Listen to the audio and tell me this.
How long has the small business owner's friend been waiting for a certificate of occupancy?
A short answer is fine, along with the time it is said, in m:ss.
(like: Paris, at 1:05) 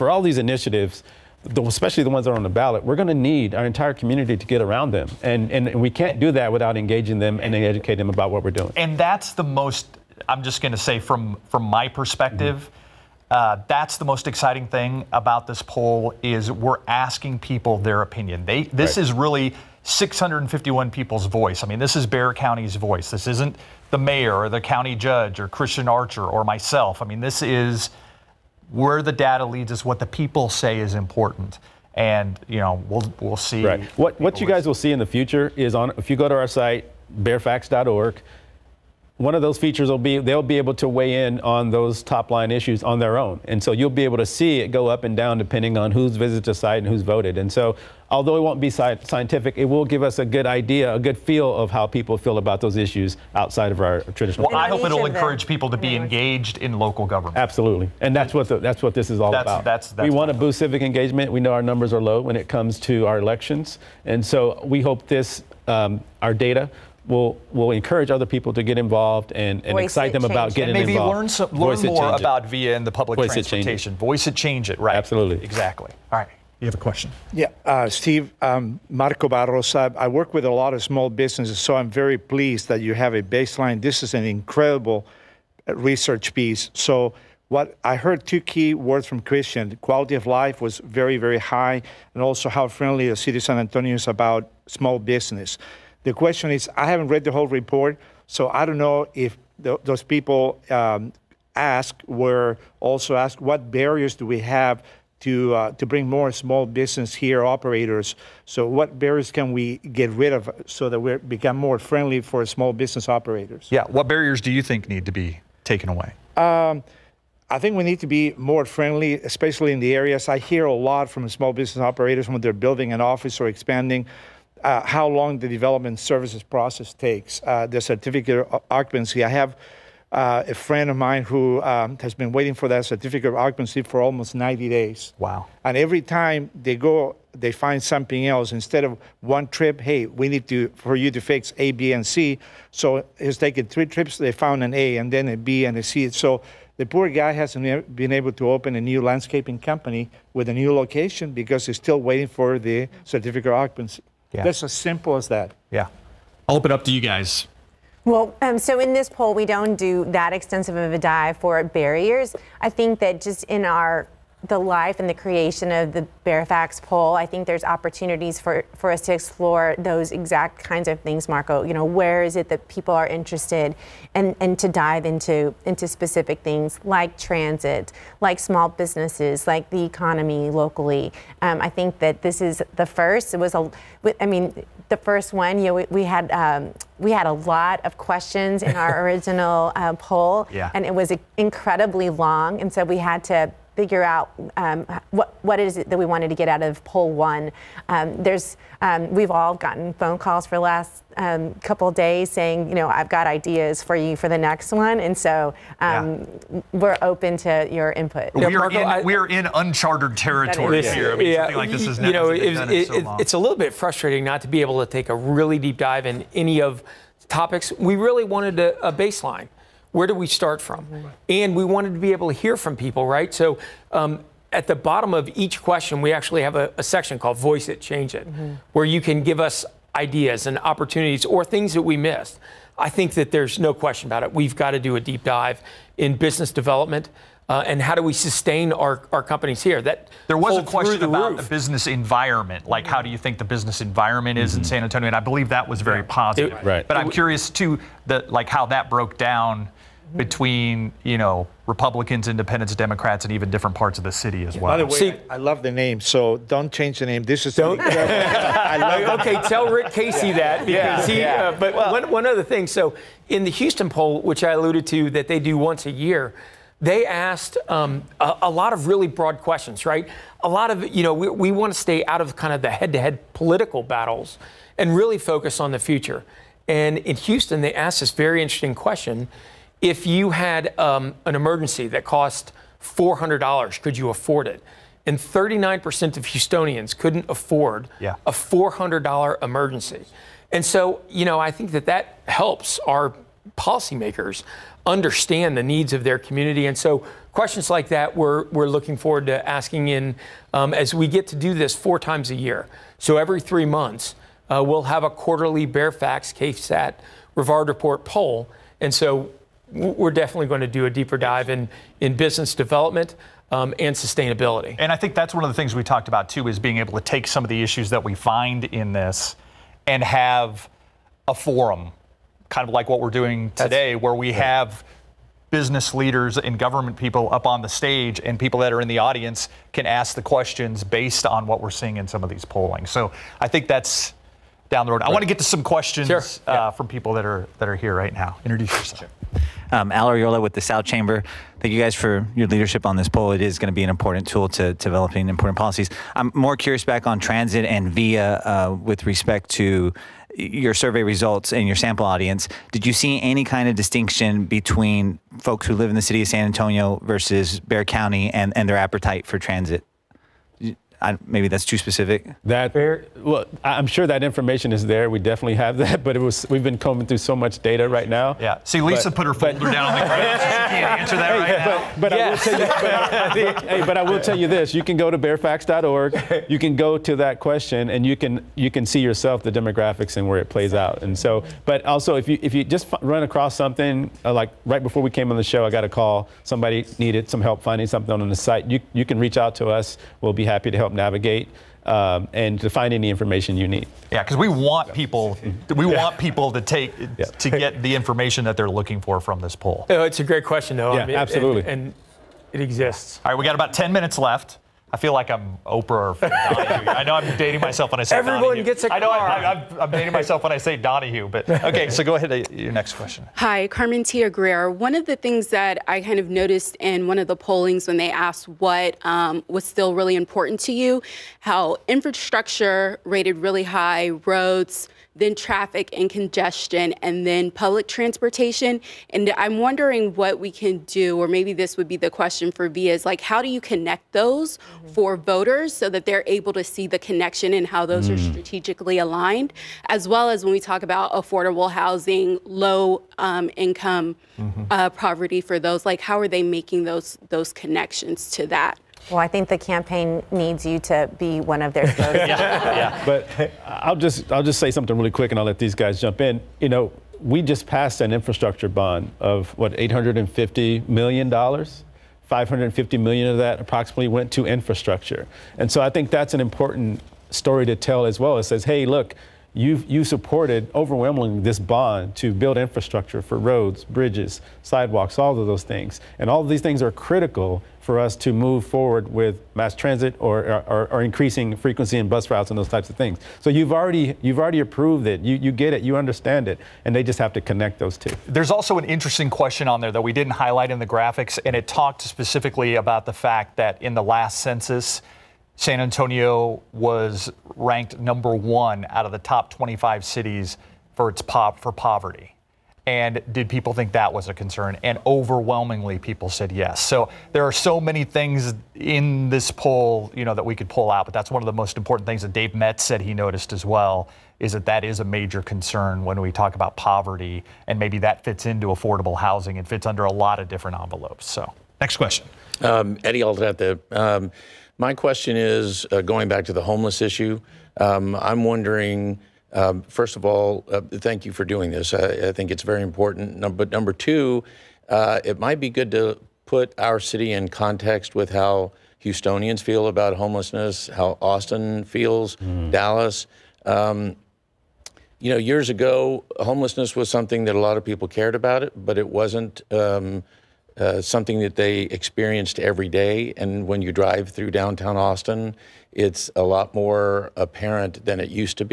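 almost 90 days, at 2:14.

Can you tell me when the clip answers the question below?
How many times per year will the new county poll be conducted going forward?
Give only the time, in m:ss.
5:01.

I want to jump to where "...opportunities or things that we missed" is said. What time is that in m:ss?
3:50.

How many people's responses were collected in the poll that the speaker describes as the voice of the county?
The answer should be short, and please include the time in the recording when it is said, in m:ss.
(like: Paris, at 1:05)
651, at 0:19.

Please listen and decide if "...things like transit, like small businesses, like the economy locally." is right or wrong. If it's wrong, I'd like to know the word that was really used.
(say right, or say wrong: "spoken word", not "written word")
right.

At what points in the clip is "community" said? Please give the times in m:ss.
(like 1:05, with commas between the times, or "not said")
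0:03, 4:56.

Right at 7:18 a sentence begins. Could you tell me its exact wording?
are strategically aligned, as well as when we talk about affordable housing, low um, income mm -hmm.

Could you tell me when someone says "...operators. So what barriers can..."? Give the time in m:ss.
1:47.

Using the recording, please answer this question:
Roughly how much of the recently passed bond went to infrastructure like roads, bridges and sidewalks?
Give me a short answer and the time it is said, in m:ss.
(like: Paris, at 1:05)
550 million, at 7:42.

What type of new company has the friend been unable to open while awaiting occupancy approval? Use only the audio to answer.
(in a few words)
landscaping company.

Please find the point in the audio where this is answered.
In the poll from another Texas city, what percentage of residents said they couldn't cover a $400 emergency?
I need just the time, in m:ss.
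4:45.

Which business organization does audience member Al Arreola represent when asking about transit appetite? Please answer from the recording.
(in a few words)
South Chamber.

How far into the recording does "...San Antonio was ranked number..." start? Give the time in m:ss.
8:15.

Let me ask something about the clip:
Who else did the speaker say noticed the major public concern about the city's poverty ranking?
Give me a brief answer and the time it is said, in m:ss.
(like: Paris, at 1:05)
Dave Metz, at 8:32.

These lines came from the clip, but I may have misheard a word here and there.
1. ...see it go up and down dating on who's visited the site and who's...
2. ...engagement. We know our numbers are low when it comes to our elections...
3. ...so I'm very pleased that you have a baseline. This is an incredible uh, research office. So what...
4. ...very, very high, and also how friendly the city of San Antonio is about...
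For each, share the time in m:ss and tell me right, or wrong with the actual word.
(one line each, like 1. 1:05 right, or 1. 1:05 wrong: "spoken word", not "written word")
1. 0:44 wrong: "depending", not "dating"
2. 1:00 right
3. 1:21 wrong: "piece", not "office"
4. 1:30 right.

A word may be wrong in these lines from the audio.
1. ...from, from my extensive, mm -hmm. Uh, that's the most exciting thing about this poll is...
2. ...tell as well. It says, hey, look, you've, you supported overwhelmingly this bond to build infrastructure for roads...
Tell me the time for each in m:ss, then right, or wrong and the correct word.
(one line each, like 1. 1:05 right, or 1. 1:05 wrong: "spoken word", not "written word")
1. 0:10 wrong: "perspective", not "extensive"
2. 7:47 right.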